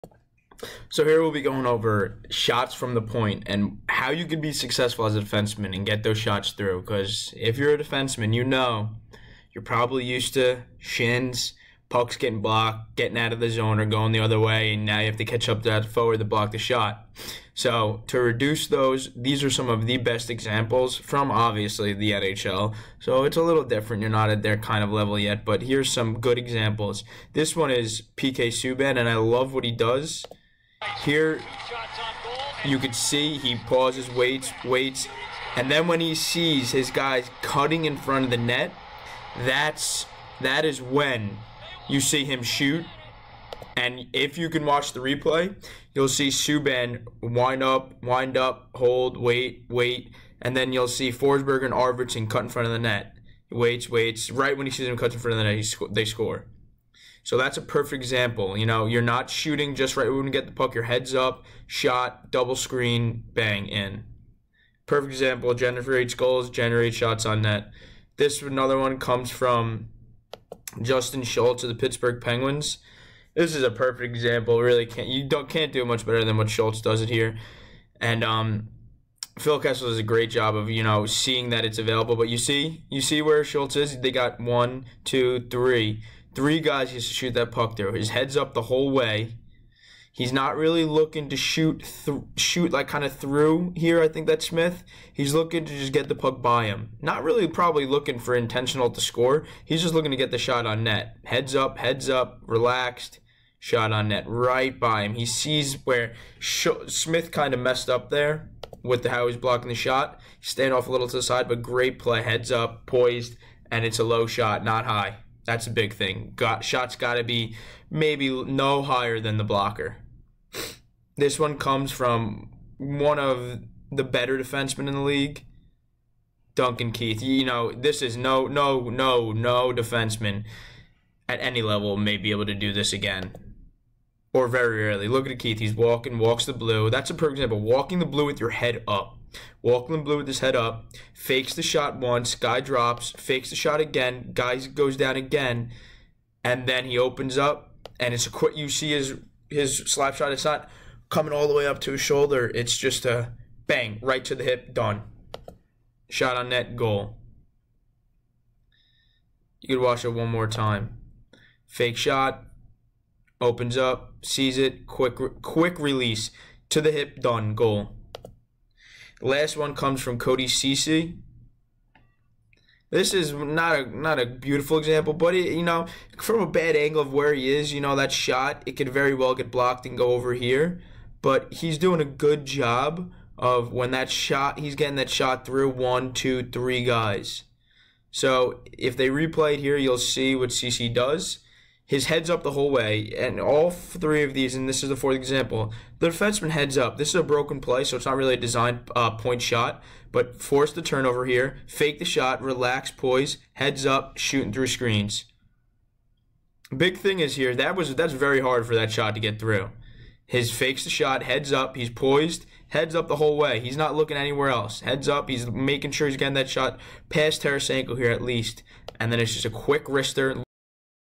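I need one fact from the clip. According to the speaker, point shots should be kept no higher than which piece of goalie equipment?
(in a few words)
The blocker.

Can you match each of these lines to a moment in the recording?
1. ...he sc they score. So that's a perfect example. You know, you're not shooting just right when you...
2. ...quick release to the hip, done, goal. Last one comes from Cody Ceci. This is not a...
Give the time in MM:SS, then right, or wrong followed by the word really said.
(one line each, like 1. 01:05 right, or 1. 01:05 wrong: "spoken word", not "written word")
1. 00:55 right
2. 02:45 right.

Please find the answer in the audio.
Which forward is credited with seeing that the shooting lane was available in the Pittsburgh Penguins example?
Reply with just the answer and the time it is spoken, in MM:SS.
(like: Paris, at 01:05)
Phil Kessel, at 01:19.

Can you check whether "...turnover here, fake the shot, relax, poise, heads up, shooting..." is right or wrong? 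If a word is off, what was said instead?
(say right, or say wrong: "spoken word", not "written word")
right.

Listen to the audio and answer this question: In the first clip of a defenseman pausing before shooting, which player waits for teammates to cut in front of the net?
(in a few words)
PK Subban.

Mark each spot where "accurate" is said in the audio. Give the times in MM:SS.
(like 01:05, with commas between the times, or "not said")
not said.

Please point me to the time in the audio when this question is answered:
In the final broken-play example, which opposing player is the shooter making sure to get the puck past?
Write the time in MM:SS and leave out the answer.
03:37.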